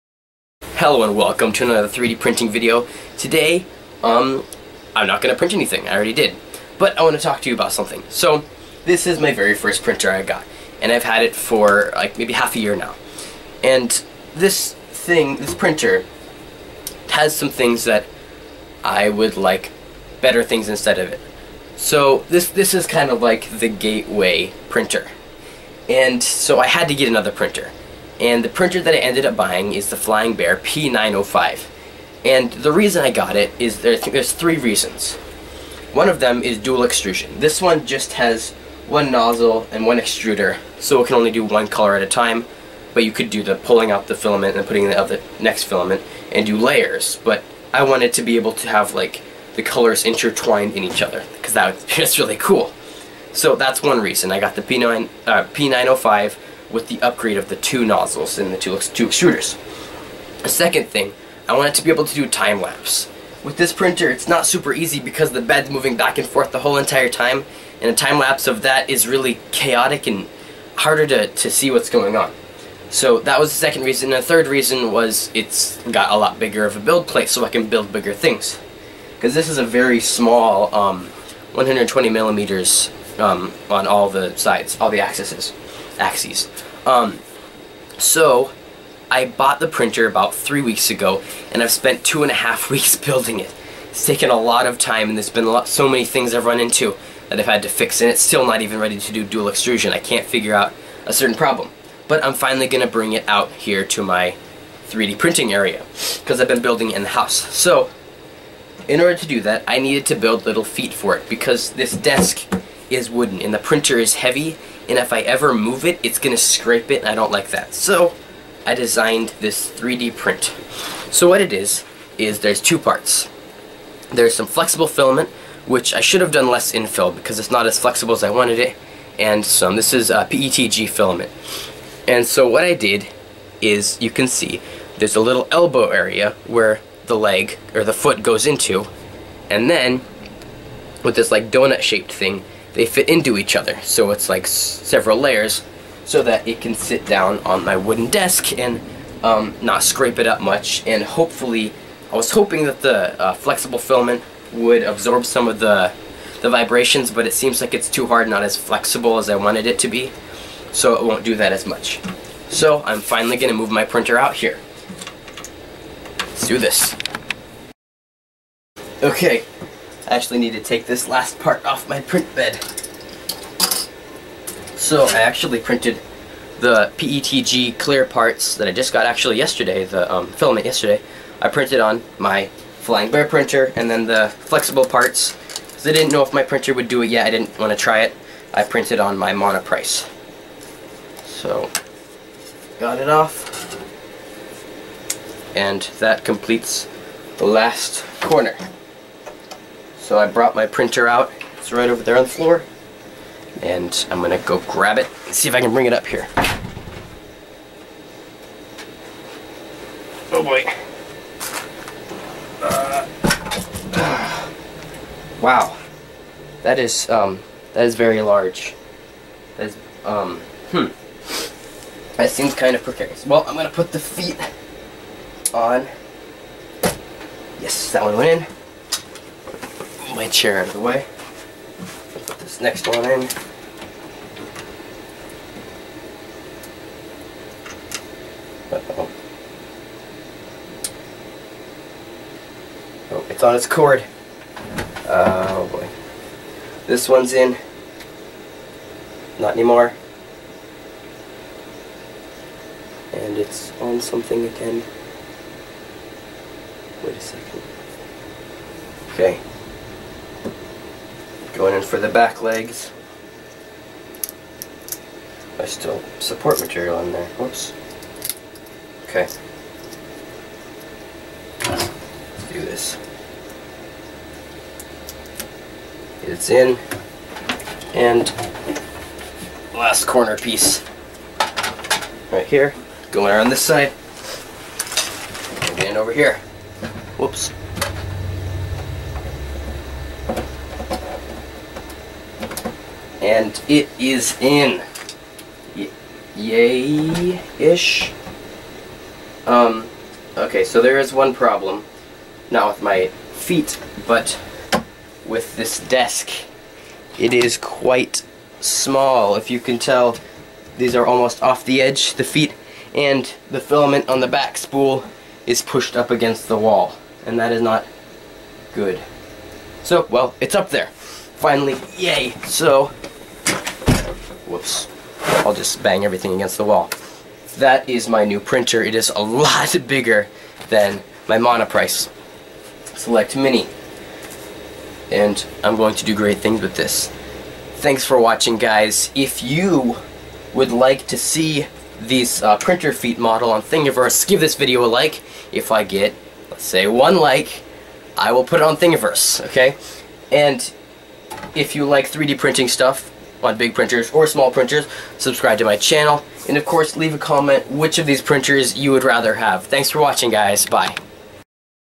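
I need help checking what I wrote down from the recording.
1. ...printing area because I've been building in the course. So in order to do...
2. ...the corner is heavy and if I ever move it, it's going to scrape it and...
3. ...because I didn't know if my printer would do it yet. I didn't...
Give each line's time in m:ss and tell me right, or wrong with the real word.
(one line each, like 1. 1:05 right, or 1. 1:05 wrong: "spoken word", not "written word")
1. 1:45 wrong: "house", not "course"
2. 1:53 wrong: "printer", not "corner"
3. 3:05 right.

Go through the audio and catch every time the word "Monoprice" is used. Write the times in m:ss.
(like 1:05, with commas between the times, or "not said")
3:09, 5:31.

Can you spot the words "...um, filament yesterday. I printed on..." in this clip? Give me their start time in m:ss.
3:00.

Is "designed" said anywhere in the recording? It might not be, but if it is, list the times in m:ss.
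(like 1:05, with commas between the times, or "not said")
1:58.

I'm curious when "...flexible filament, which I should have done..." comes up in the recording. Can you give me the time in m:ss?
2:04.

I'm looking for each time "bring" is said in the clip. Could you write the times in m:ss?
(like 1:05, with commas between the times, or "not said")
1:42, 3:25.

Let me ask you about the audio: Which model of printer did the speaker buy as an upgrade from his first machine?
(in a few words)
Flying Bear P905.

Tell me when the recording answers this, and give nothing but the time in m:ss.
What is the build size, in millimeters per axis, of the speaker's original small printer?
1:21.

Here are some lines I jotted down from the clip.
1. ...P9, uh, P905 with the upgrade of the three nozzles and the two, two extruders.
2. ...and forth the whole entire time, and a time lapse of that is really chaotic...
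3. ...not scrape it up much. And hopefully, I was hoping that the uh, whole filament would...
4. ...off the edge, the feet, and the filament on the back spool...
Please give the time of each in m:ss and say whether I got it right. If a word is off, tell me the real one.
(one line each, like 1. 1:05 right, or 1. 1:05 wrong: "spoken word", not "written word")
1. 0:54 wrong: "two", not "three"
2. 1:06 right
3. 2:29 wrong: "flexible", not "whole"
4. 5:11 right.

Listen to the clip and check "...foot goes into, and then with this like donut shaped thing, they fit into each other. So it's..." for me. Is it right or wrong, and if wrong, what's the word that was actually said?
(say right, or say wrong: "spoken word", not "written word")
right.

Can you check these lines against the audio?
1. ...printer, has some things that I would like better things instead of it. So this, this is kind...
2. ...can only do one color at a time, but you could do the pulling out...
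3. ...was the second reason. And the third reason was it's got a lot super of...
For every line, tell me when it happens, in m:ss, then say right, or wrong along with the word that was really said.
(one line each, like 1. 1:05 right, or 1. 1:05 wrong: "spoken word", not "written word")
1. 0:15 right
2. 0:41 right
3. 1:13 wrong: "bigger", not "super".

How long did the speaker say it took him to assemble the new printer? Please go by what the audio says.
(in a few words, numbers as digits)
2.5 weeks.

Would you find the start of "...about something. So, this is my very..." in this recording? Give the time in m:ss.
0:07.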